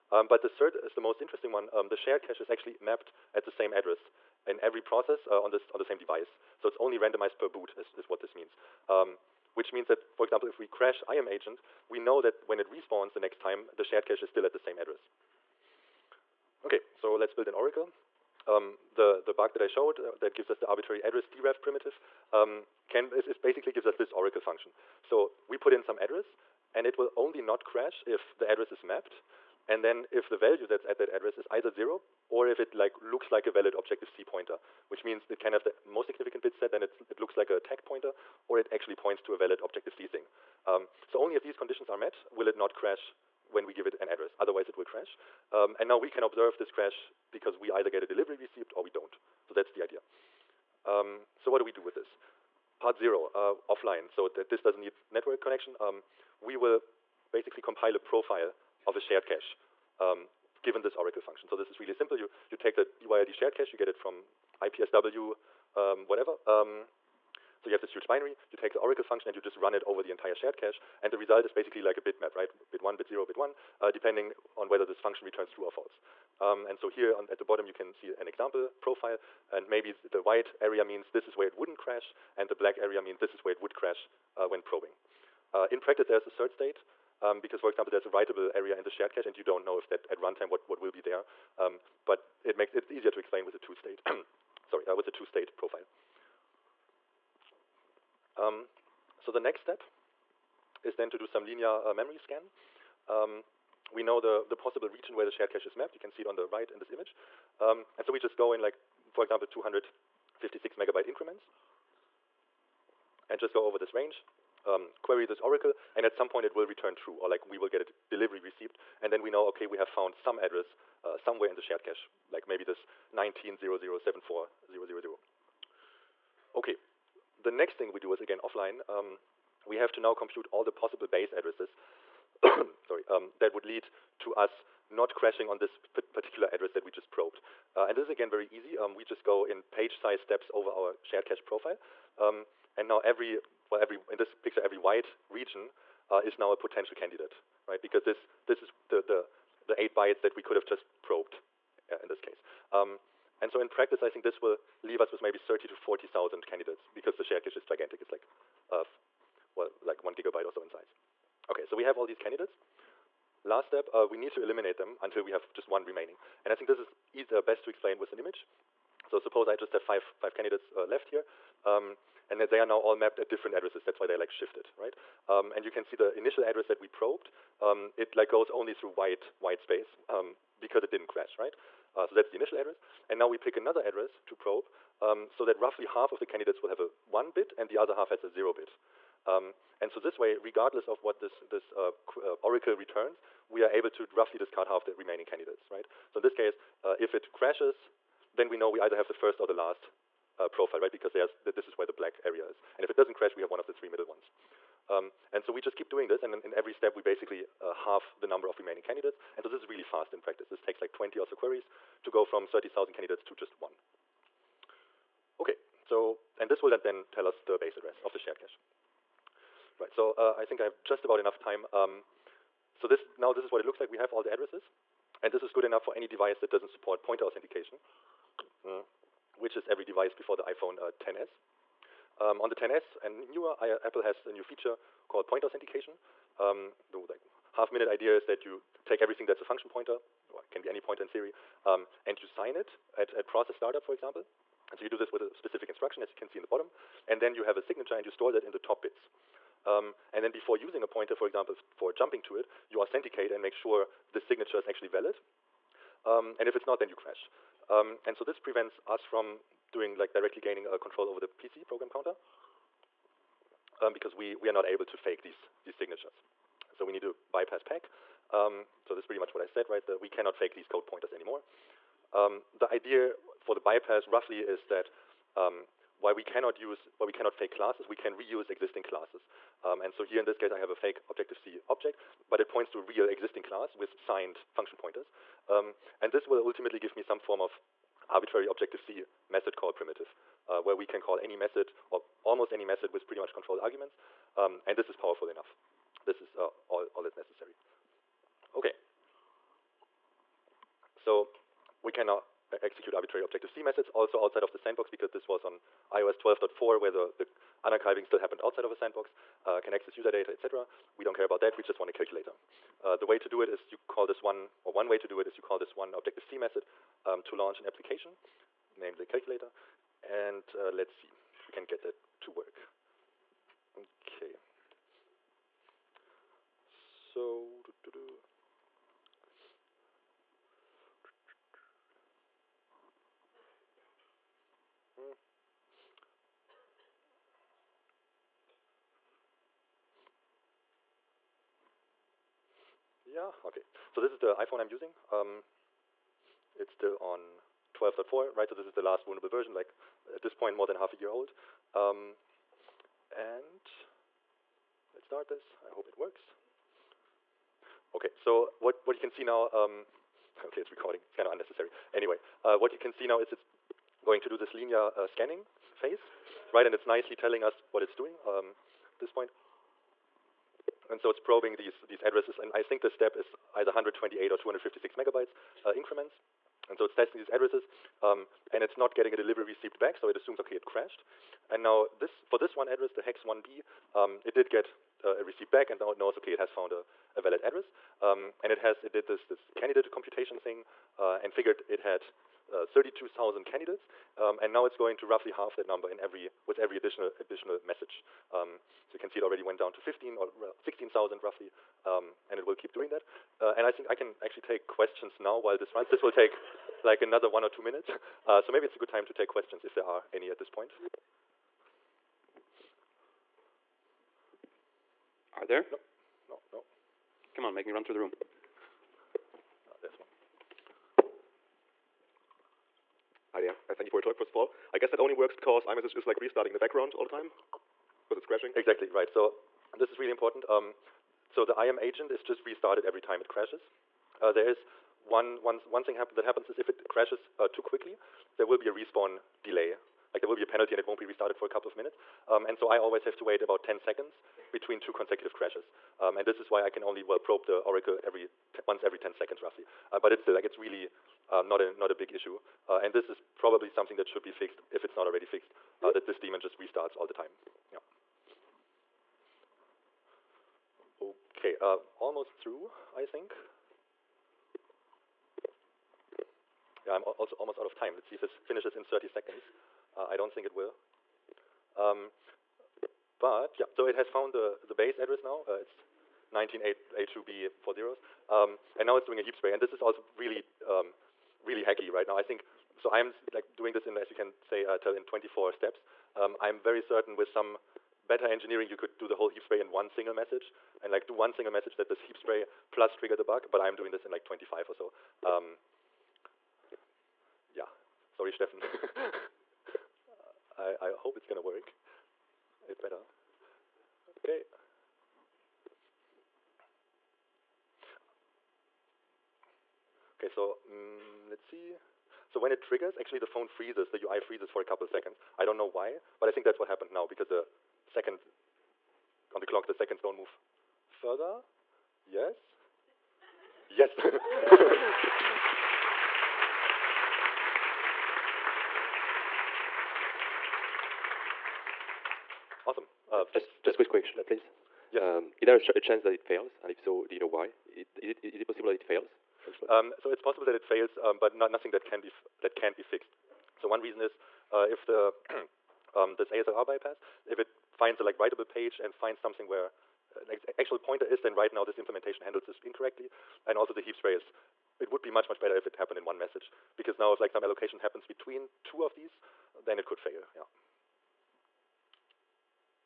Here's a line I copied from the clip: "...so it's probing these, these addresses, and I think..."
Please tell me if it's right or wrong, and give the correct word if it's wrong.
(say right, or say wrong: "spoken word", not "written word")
right.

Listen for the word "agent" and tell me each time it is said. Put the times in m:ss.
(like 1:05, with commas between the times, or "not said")
0:11, 7:11.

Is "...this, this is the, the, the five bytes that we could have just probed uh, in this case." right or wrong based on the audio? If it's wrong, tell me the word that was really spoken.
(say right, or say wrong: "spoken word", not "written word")
wrong: "eight", not "five".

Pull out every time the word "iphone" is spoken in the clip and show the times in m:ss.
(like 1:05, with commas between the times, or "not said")
3:50, 5:44.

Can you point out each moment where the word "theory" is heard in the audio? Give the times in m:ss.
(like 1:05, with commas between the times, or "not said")
4:01.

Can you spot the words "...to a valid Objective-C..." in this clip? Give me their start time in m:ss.
0:39.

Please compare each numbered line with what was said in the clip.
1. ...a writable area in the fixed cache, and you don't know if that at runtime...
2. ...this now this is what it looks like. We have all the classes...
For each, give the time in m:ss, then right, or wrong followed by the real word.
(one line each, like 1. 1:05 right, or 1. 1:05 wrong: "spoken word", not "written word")
1. 1:28 wrong: "shared", not "fixed"
2. 3:42 wrong: "addresses", not "classes".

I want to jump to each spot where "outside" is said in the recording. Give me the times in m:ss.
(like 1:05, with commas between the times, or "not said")
5:04, 5:08.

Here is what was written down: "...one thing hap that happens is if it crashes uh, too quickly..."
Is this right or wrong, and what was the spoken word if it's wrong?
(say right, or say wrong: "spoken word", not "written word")
right.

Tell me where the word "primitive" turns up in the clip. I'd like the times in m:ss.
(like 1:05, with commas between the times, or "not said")
0:21, 4:49.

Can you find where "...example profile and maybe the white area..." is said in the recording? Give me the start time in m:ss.
1:18.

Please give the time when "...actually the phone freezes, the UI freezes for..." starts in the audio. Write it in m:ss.
8:32.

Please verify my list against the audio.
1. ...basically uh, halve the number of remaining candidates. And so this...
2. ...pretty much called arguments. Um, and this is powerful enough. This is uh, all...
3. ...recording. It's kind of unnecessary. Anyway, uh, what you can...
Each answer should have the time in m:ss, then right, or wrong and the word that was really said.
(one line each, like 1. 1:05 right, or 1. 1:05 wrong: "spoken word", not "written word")
1. 3:27 right
2. 4:53 wrong: "controlled", not "called"
3. 6:00 right.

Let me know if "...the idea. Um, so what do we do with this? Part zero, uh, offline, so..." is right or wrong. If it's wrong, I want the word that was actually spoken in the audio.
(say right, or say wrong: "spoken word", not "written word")
right.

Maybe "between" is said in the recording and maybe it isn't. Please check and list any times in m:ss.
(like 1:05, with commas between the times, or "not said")
7:24, 9:18.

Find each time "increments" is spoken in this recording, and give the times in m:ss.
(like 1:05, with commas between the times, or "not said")
1:51, 6:15.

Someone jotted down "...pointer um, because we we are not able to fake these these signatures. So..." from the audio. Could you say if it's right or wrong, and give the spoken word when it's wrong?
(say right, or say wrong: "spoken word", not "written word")
wrong: "counter", not "pointer".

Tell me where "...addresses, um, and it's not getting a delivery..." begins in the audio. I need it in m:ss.
6:17.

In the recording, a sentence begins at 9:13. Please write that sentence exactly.
And also the heap spray is, it would be much, much better if it happened in one message.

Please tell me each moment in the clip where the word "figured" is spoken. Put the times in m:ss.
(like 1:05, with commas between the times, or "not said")
6:31.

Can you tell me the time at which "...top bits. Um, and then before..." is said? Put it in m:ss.
4:08.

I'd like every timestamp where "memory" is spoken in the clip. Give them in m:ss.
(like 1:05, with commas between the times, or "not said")
1:41.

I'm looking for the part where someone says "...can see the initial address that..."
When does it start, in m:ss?
2:55.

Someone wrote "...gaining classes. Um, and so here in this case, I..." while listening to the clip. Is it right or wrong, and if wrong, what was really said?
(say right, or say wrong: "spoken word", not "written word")
wrong: "existing", not "gaining".